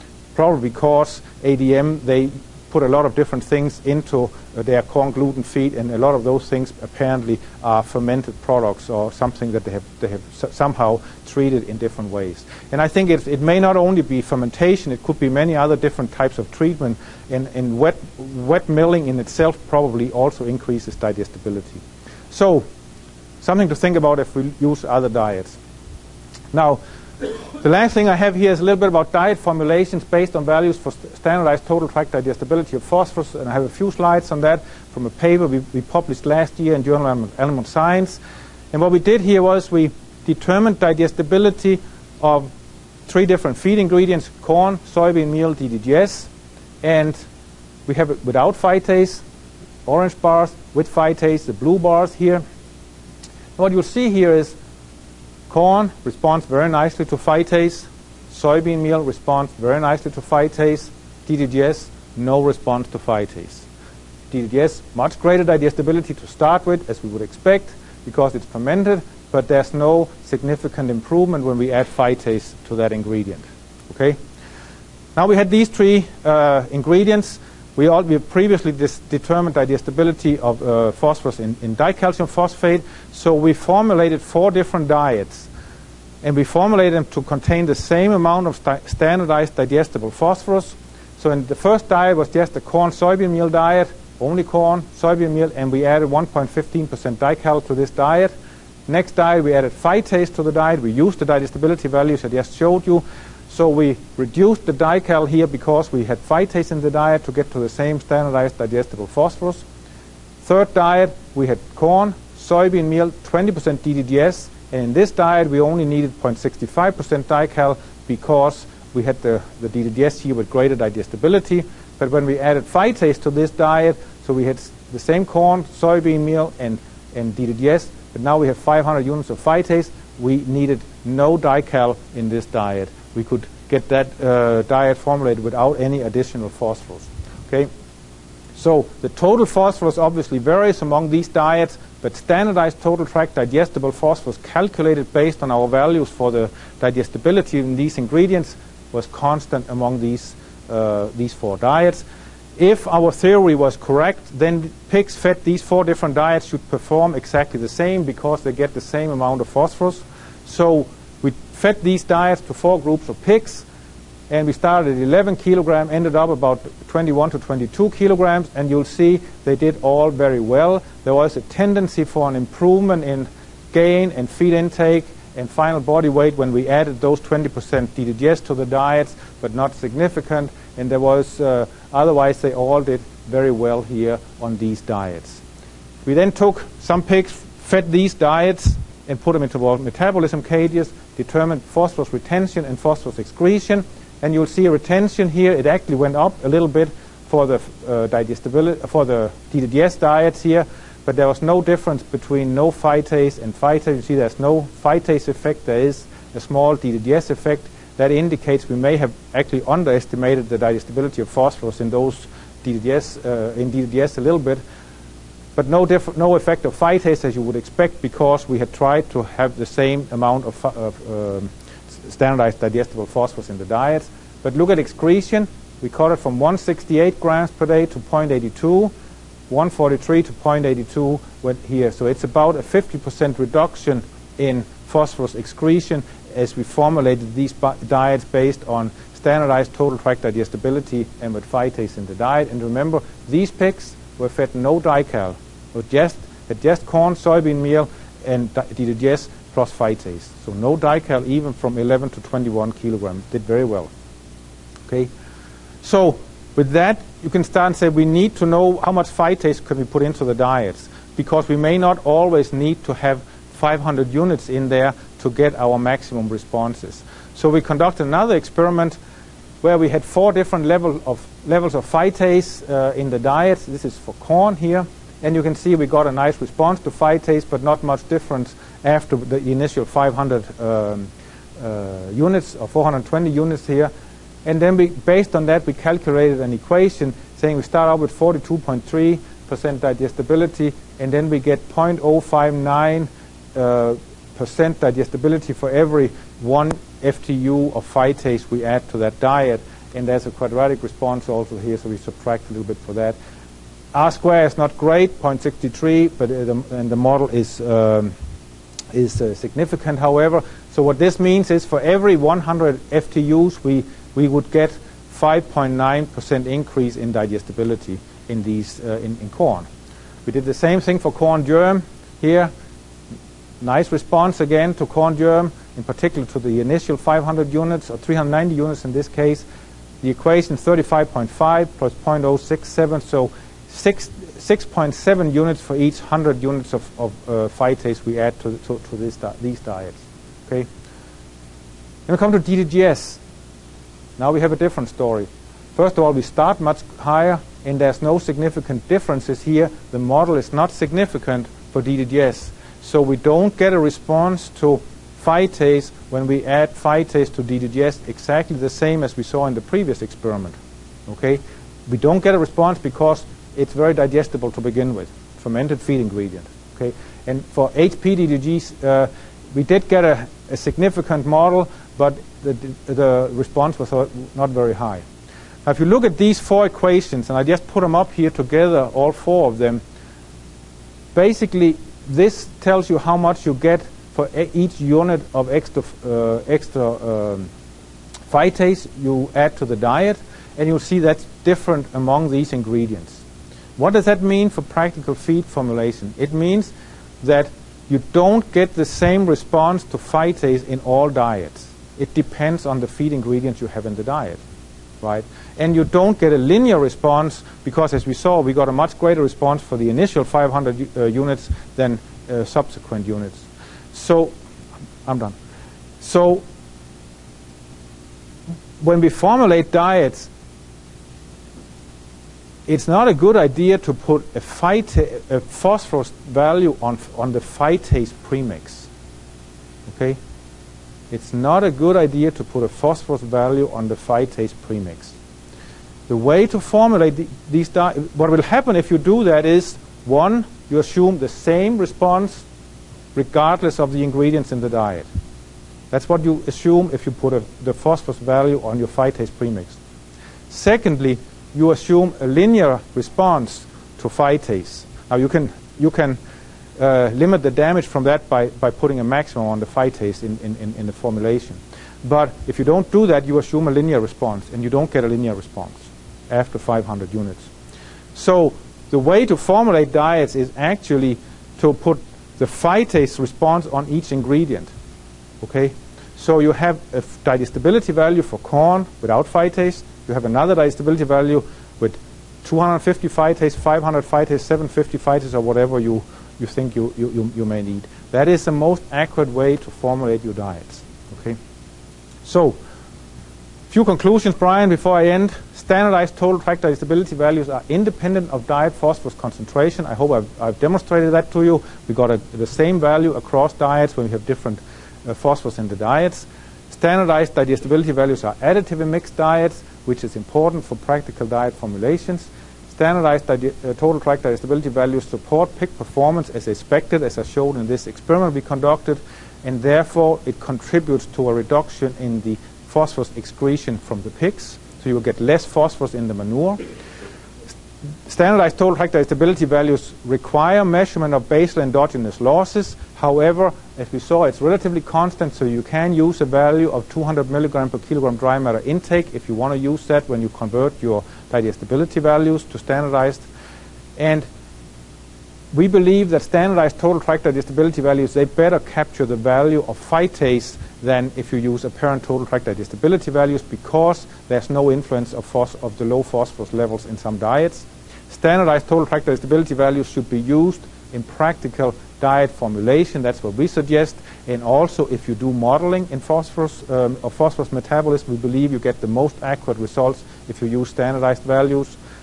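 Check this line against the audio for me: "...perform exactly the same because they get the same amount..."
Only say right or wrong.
right.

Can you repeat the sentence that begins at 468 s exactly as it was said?
So the way to formulate diets is actually to put the phytase response on each ingredient.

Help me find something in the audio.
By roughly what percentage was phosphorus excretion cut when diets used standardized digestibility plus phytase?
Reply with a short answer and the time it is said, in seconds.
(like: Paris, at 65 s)
50%, at 232 s.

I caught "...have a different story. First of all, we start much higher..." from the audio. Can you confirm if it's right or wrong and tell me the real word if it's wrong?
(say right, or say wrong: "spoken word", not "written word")
right.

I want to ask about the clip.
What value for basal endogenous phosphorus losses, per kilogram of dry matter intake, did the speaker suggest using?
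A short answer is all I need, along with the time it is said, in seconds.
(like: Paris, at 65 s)
200 milligrams, at 536 s.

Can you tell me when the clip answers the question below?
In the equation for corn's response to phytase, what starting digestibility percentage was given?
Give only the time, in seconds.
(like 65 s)
288 s.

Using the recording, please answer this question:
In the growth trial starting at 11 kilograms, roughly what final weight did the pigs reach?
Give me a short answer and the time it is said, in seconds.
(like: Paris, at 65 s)
21 to 22 kilograms, at 166 s.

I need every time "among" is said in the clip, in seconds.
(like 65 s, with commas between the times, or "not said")
140 s, 149 s, 391 s.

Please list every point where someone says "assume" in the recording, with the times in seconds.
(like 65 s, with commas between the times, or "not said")
440 s, 446 s, 451 s, 463 s.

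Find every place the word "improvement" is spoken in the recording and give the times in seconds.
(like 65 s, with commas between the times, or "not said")
70 s, 172 s.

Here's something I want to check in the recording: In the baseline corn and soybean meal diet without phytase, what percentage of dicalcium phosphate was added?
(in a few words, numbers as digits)
1.15%.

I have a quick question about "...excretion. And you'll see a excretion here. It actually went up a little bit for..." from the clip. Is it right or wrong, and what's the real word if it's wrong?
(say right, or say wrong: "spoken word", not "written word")
wrong: "retention", not "excretion".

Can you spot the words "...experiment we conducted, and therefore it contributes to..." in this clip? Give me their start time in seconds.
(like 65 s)
517 s.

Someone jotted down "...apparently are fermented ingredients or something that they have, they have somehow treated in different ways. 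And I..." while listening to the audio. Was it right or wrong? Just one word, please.
wrong.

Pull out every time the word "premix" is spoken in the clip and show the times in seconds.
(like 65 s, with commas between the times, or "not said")
428 s, 434 s, 449 s.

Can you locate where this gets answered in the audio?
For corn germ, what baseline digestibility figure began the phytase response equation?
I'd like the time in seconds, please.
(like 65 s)
330 s.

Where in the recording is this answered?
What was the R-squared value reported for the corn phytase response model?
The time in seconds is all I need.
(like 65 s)
305 s.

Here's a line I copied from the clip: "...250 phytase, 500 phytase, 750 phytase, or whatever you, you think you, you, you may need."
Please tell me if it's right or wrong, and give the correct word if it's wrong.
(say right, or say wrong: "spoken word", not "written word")
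right.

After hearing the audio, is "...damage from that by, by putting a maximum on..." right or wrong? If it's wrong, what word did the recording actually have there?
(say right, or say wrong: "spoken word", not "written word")
right.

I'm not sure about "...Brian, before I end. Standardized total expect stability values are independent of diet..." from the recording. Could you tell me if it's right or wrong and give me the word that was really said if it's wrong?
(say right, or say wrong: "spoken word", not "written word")
wrong: "tract", not "expect".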